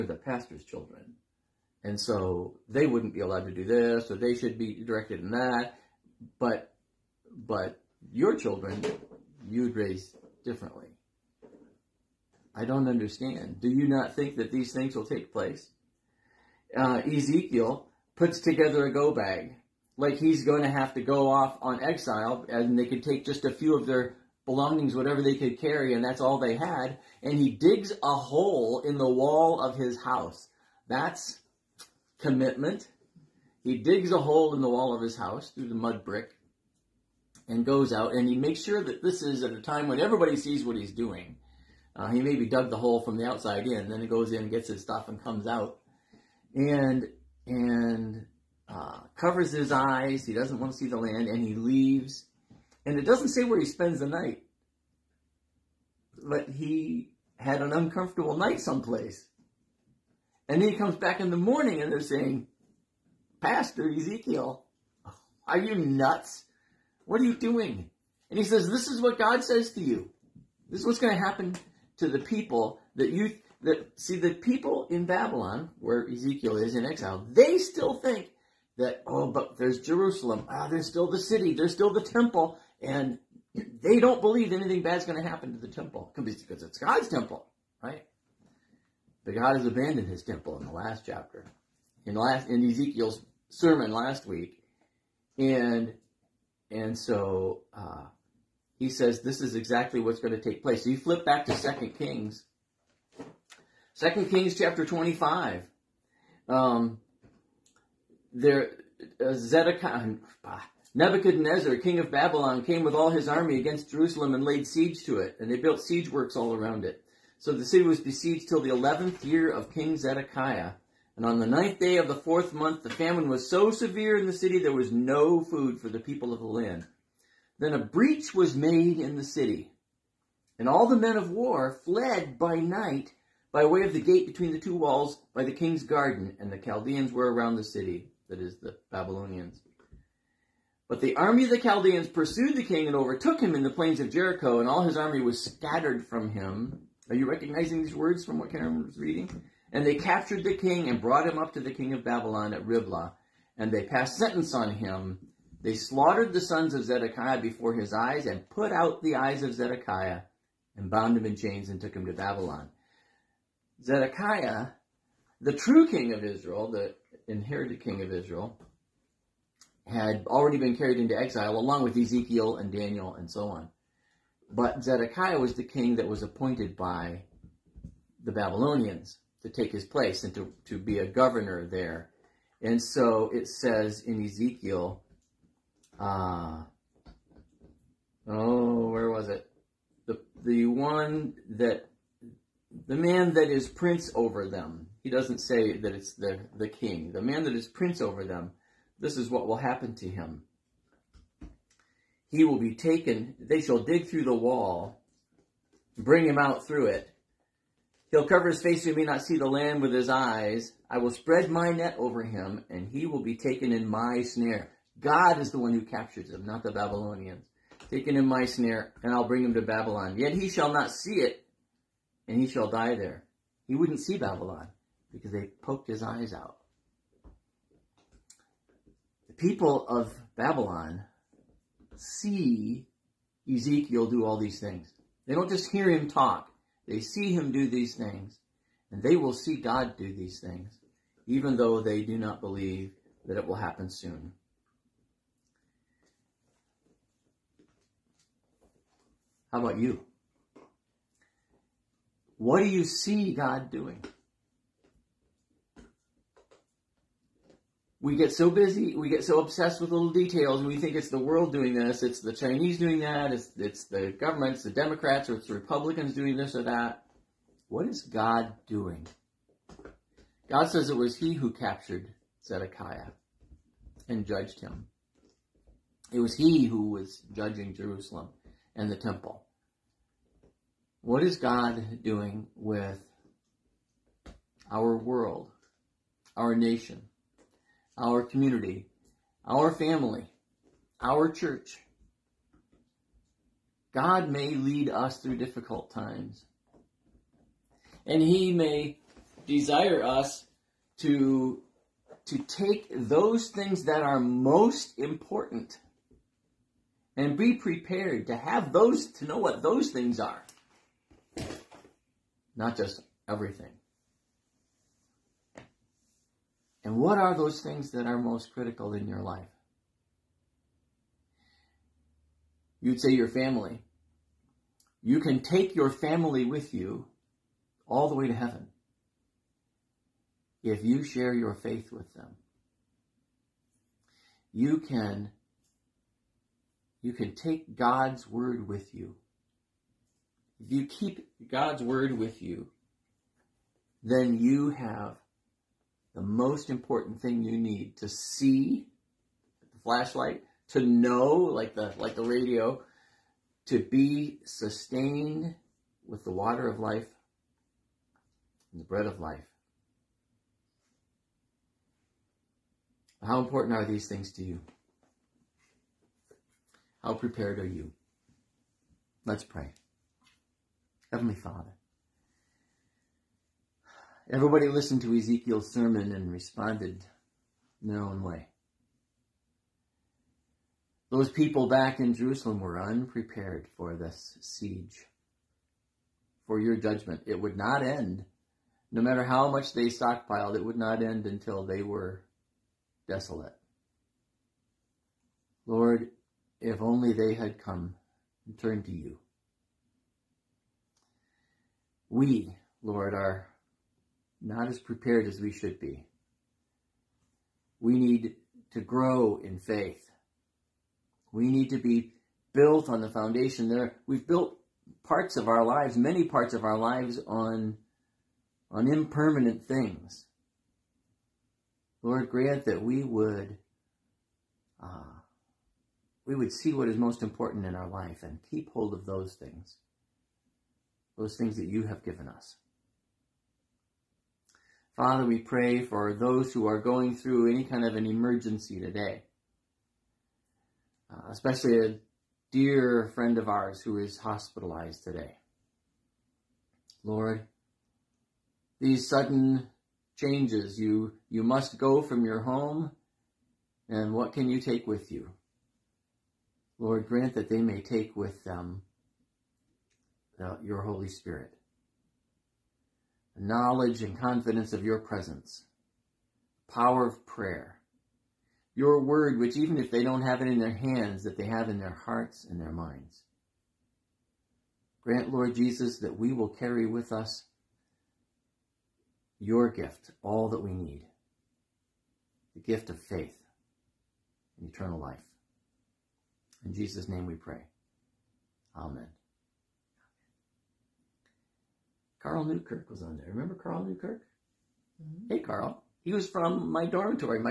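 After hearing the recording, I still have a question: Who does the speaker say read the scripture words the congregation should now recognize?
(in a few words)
Karen.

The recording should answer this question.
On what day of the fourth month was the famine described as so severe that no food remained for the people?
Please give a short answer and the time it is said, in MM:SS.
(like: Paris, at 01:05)
9th day, at 02:01.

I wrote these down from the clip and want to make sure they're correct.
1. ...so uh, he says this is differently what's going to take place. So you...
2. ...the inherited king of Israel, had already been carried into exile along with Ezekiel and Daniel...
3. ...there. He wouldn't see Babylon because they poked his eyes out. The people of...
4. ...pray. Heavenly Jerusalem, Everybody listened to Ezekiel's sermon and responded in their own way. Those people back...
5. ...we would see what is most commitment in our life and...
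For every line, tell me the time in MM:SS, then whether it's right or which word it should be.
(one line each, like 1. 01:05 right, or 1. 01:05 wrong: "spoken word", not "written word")
1. 01:36 wrong: "exactly", not "differently"
2. 02:46 right
3. 03:42 right
4. 06:09 wrong: "Father", not "Jerusalem"
5. 07:06 wrong: "important", not "commitment".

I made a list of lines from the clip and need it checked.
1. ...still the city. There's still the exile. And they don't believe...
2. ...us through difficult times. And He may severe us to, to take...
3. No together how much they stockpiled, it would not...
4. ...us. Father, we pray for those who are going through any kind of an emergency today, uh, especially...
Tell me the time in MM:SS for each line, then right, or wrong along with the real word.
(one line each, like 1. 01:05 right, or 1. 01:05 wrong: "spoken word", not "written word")
1. 01:20 wrong: "temple", not "exile"
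2. 04:54 wrong: "desire", not "severe"
3. 06:28 wrong: "matter", not "together"
4. 07:12 right.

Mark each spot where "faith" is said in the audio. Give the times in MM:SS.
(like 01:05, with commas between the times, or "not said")
05:31, 06:49, 08:03.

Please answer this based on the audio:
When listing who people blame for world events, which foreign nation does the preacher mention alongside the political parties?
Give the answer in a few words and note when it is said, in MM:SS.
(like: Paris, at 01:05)
the Chinese, at 04:22.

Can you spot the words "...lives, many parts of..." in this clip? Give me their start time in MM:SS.
06:55.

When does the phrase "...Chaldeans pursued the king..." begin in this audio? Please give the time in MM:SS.
02:21.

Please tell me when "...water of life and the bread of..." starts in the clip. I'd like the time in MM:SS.
05:56.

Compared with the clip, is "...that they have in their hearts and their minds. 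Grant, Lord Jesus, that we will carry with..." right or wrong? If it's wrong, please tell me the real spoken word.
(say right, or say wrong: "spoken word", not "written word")
right.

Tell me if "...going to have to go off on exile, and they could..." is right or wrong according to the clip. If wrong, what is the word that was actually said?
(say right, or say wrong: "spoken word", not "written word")
right.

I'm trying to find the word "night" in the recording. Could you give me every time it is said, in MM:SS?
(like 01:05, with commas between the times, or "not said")
00:54, 00:58, 02:12.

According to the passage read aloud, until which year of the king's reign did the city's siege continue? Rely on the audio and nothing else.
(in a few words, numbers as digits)
11th year.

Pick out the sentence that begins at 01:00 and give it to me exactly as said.
And then he comes back in the morning, and they're saying, Pastor Ezekiel, are you nuts?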